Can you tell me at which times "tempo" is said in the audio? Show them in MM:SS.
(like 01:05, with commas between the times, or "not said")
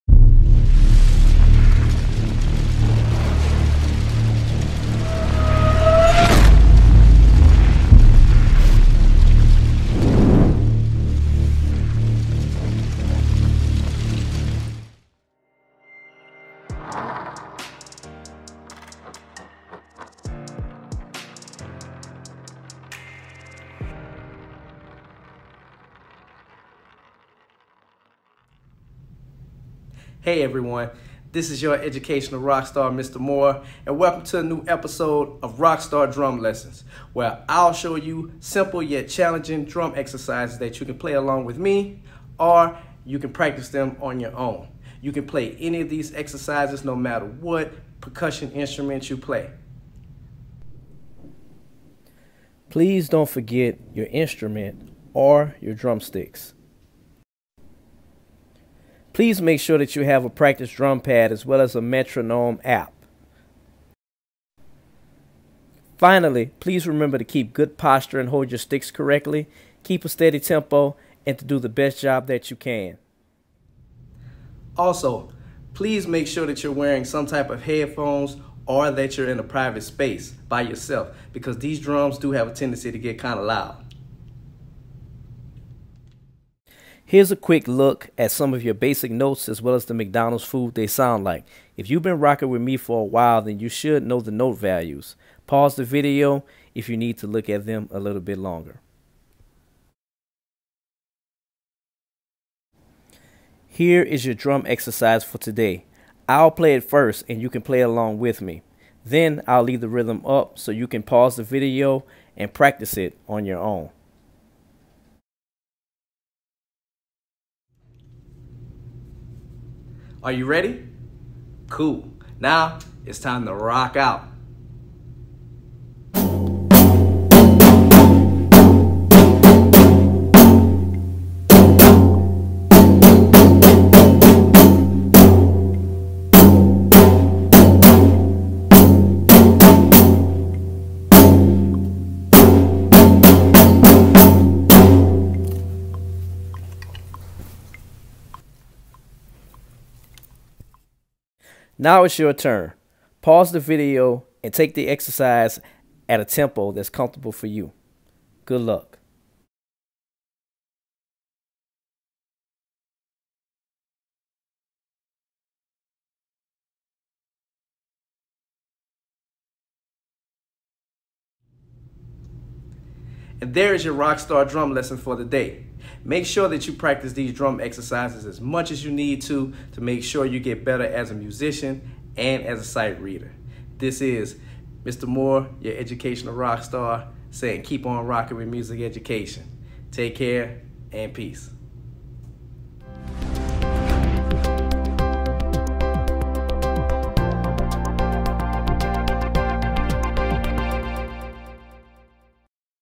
01:10, 02:36.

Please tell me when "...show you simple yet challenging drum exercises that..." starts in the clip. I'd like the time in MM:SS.
00:37.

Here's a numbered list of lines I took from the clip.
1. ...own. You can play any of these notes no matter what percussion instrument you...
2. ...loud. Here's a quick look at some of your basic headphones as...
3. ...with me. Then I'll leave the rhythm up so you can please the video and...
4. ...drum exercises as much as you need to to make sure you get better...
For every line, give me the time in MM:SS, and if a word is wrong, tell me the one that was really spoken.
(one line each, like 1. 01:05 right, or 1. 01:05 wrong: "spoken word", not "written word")
1. 00:44 wrong: "exercises", not "notes"
2. 01:23 wrong: "notes", not "headphones"
3. 01:48 wrong: "pause", not "please"
4. 02:57 right.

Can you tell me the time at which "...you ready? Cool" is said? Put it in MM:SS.
02:00.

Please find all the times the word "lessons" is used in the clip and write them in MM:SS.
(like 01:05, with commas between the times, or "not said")
00:36, 02:54.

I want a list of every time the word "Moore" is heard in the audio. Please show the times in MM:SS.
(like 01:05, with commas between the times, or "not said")
00:33, 03:05.